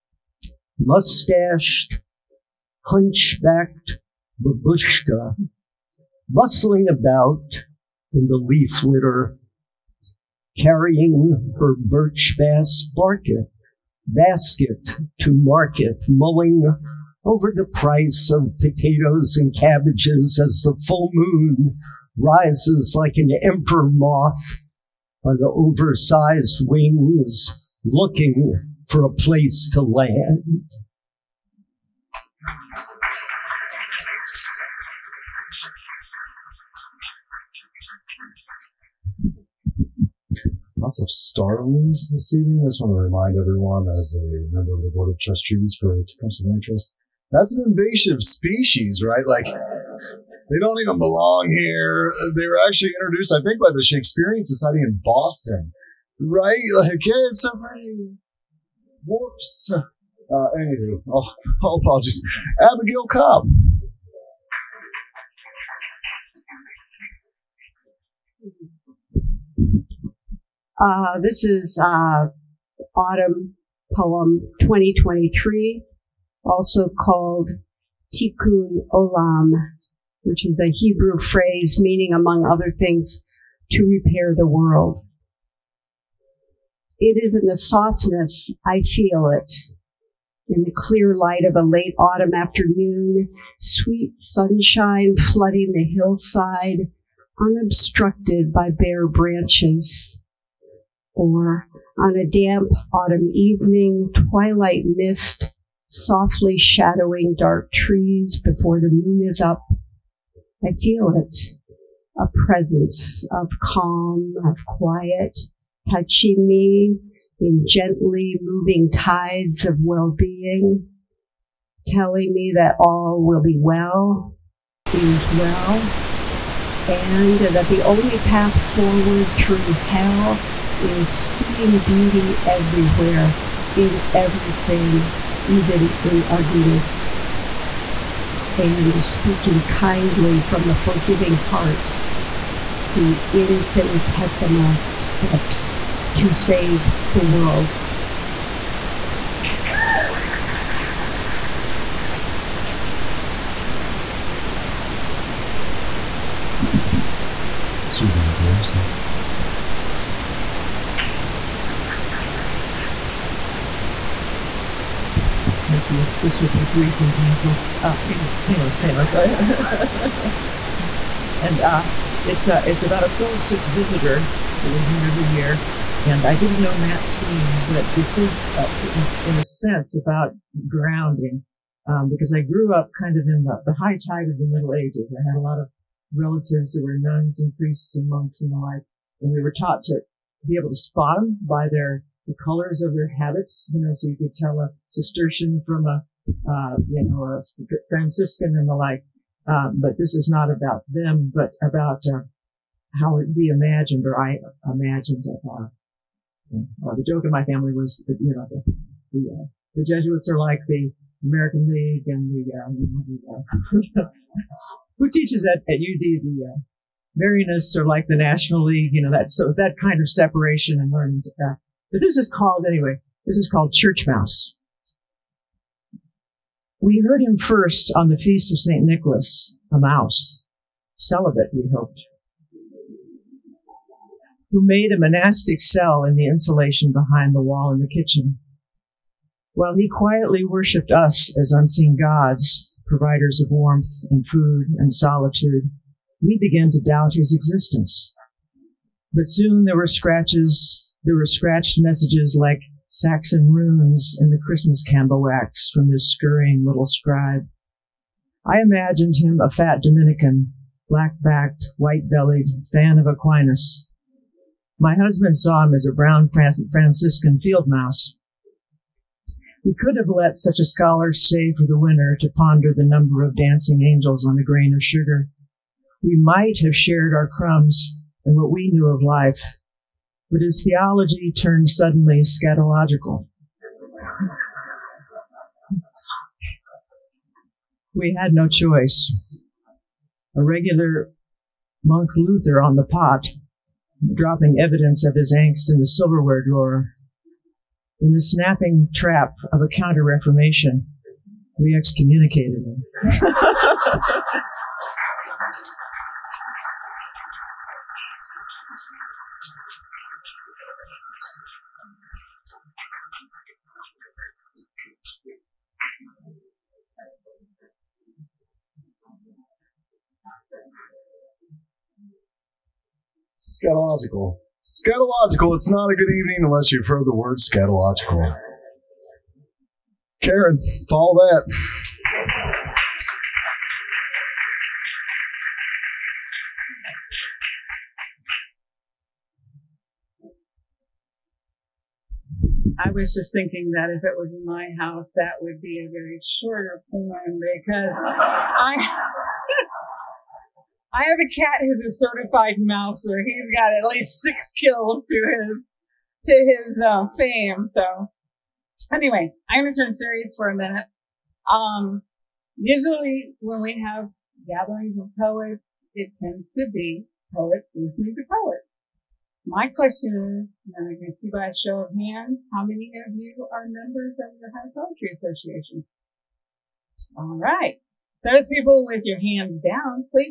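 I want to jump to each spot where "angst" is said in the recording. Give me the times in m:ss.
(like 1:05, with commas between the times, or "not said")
4:55.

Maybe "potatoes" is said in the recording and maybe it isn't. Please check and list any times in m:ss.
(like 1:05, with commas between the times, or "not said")
0:18.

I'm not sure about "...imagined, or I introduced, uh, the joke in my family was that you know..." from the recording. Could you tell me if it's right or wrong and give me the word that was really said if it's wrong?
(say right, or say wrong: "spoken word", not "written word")
wrong: "imagined", not "introduced".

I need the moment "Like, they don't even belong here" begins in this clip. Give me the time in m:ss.
0:49.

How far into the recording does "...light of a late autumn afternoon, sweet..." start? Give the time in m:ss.
1:31.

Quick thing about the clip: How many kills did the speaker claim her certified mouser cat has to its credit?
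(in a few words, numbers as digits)
at least 6.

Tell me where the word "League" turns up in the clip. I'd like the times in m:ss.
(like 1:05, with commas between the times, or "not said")
3:31, 3:38.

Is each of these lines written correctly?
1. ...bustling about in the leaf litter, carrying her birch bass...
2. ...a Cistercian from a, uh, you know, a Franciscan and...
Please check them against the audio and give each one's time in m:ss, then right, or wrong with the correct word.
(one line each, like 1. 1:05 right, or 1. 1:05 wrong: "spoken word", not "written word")
1. 0:06 right
2. 3:14 right.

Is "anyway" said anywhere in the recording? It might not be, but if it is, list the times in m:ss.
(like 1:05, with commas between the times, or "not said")
1:00, 3:42, 5:58.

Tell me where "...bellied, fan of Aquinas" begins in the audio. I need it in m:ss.
4:22.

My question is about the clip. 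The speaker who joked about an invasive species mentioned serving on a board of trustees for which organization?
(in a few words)
Tecumseh Land Trust.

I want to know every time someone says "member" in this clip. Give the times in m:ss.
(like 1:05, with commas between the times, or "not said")
0:44, 6:13.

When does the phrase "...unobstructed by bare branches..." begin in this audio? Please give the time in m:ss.
1:37.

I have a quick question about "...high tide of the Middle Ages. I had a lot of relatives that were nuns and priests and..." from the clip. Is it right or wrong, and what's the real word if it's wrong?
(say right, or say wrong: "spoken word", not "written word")
right.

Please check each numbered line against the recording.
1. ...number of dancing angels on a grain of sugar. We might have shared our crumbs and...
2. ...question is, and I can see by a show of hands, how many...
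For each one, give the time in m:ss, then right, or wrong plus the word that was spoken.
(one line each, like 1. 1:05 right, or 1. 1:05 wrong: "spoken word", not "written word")
1. 4:32 right
2. 6:09 right.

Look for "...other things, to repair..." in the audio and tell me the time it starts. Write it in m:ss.
1:22.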